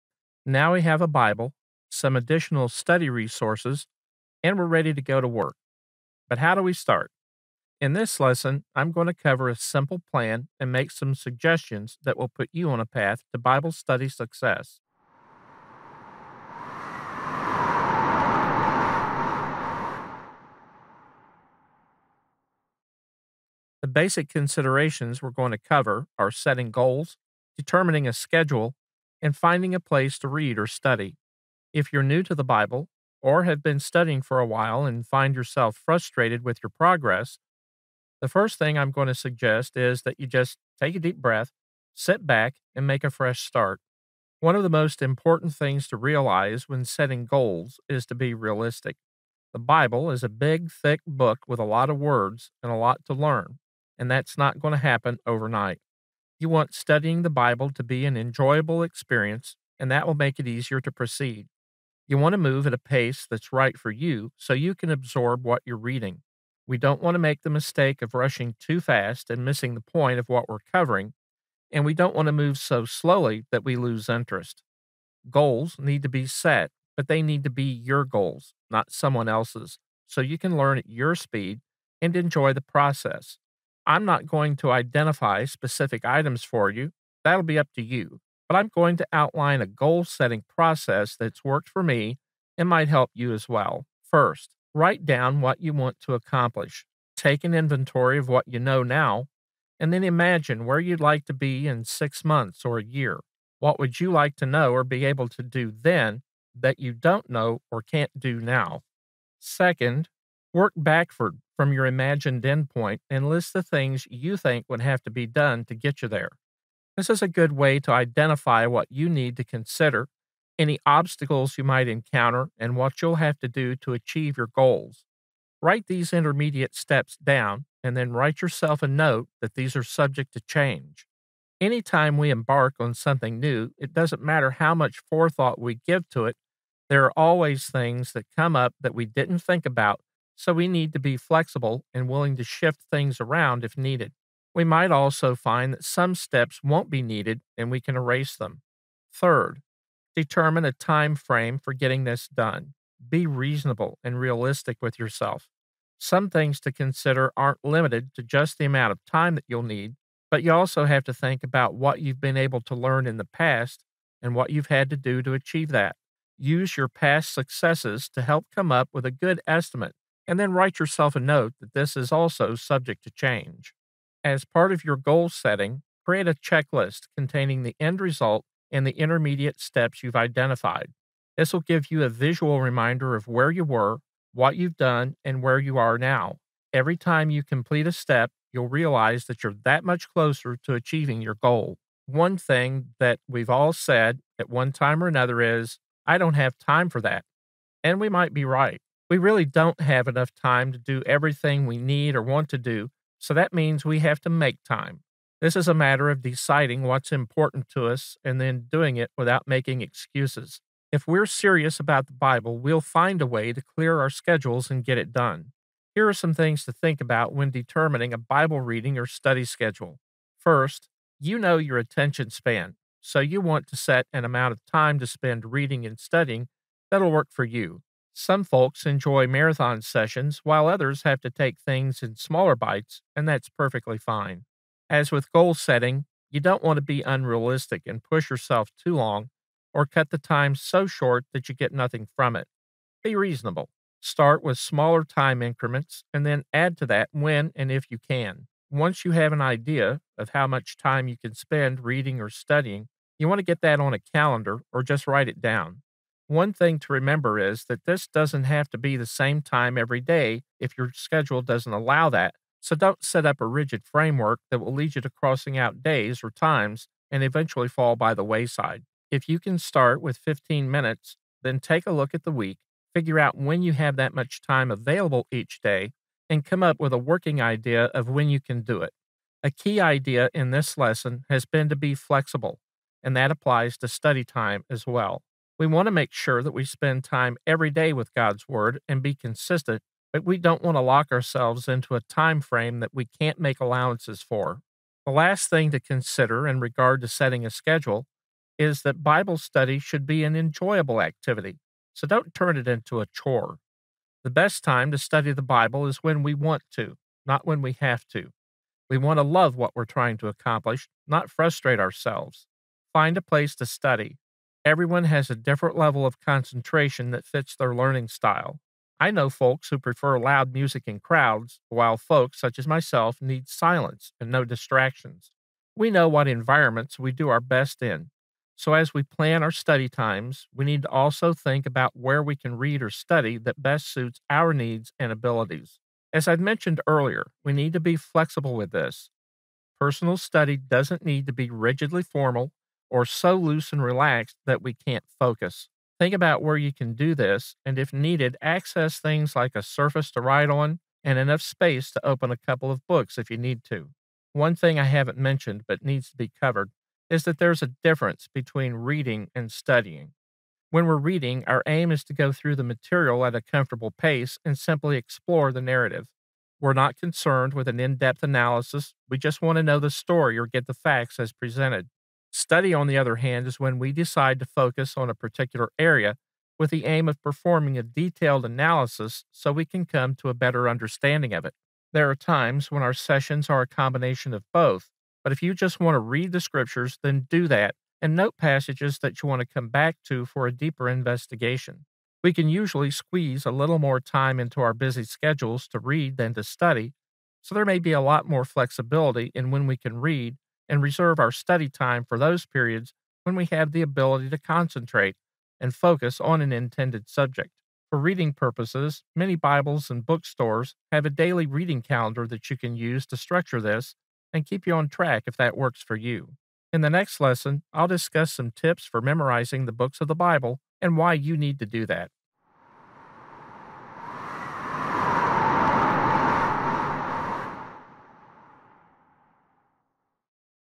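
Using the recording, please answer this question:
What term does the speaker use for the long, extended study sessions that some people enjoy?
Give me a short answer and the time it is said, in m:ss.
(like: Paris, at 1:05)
Marathon sessions, at 3:49.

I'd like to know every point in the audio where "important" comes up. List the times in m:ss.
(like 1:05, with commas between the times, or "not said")
0:45, 3:27.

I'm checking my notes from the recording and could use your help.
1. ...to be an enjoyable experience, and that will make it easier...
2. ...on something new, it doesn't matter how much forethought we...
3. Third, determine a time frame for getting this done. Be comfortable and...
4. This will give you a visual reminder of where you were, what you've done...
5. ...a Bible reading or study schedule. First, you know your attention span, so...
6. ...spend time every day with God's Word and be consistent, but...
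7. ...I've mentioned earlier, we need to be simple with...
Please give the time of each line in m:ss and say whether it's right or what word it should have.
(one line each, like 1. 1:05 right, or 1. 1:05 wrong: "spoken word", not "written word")
1. 0:57 right
2. 2:12 right
3. 2:29 wrong: "reasonable", not "comfortable"
4. 3:01 right
5. 3:38 right
6. 4:46 right
7. 5:36 wrong: "flexible", not "simple".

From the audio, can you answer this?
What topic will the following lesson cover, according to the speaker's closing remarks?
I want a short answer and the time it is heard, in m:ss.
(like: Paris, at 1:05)
Memorizing the books of the Bible, at 6:59.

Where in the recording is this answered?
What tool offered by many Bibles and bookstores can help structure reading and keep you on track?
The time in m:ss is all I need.
6:51.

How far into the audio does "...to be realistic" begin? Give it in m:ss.
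0:48.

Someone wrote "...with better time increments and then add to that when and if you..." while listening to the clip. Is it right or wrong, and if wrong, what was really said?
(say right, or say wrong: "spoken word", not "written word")
wrong: "smaller", not "better".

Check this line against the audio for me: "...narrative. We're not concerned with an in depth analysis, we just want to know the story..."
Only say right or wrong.
right.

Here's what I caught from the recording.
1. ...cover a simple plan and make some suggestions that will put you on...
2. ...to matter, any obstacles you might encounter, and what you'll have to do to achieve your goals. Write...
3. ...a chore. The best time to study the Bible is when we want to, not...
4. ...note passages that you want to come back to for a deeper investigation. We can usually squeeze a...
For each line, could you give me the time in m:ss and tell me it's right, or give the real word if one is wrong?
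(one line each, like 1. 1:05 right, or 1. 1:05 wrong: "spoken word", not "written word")
1. 0:09 right
2. 1:59 wrong: "consider", not "matter"
3. 5:02 right
4. 6:28 right.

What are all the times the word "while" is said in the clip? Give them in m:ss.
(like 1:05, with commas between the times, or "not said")
0:34, 3:50, 5:21.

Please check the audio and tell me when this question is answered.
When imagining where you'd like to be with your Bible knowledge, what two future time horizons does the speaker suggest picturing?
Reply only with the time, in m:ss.
1:41.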